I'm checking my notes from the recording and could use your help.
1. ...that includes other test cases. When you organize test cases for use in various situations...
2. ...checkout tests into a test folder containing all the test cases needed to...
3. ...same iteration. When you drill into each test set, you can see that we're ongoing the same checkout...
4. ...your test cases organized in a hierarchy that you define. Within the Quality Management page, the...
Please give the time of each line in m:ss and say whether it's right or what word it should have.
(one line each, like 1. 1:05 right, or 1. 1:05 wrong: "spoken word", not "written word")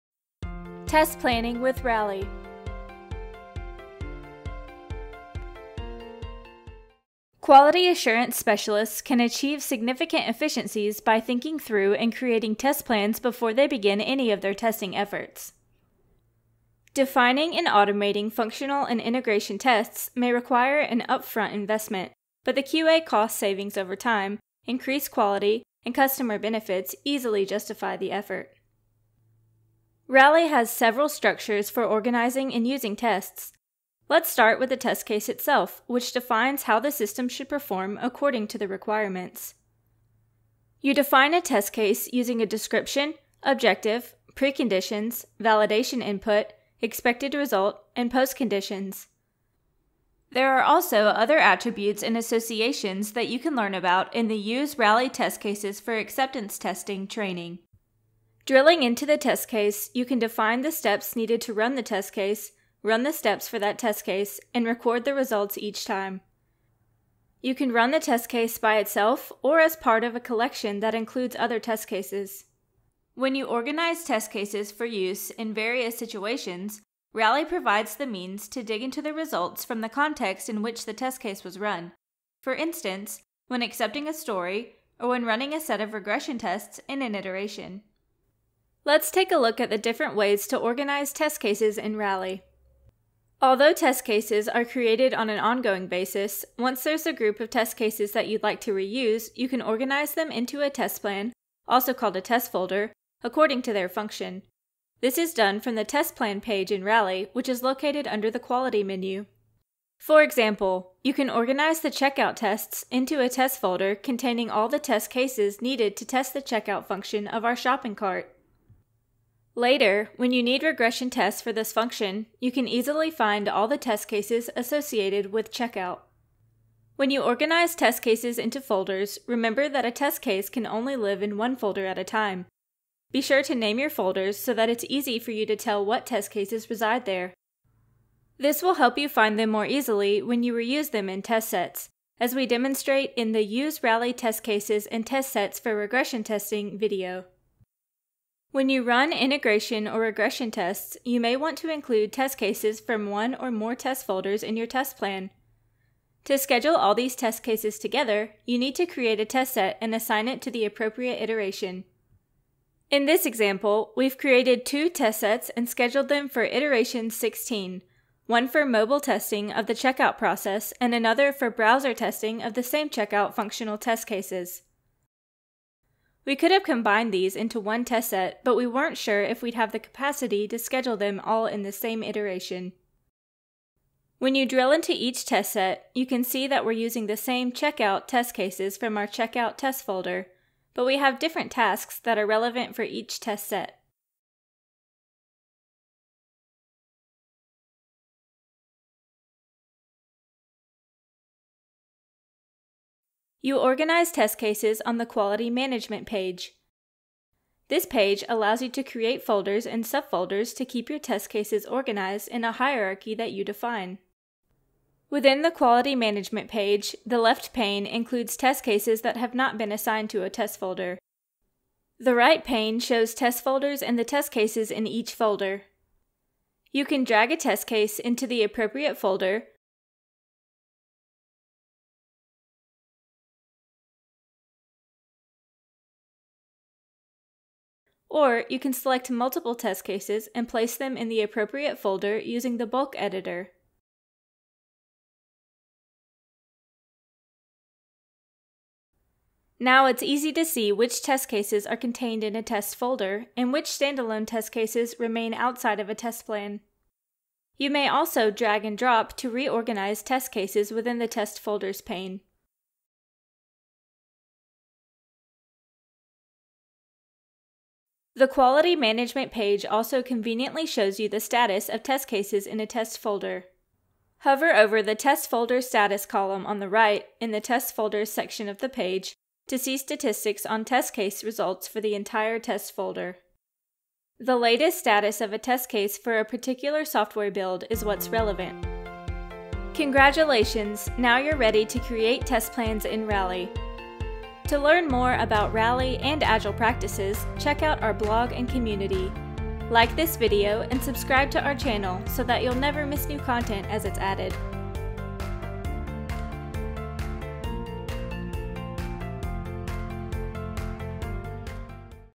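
1. 1:10 right
2. 1:51 right
3. 3:01 wrong: "using", not "ongoing"
4. 3:30 right.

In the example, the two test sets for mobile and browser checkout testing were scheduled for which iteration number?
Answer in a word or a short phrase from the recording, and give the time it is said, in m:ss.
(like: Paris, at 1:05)
16, at 2:46.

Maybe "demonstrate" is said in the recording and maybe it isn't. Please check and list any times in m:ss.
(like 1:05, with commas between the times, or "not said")
2:22.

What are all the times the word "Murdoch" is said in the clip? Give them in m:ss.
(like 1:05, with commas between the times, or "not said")
not said.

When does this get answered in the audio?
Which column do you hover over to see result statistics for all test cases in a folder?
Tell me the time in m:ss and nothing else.
4:34.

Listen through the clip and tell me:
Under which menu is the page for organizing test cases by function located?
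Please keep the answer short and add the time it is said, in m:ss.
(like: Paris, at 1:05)
quality menu, at 1:48.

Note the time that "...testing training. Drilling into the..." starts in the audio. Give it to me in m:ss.
0:56.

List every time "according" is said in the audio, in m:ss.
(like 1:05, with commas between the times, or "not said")
0:38, 1:43.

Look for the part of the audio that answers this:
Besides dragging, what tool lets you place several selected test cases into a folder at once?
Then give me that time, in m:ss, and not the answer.
4:02.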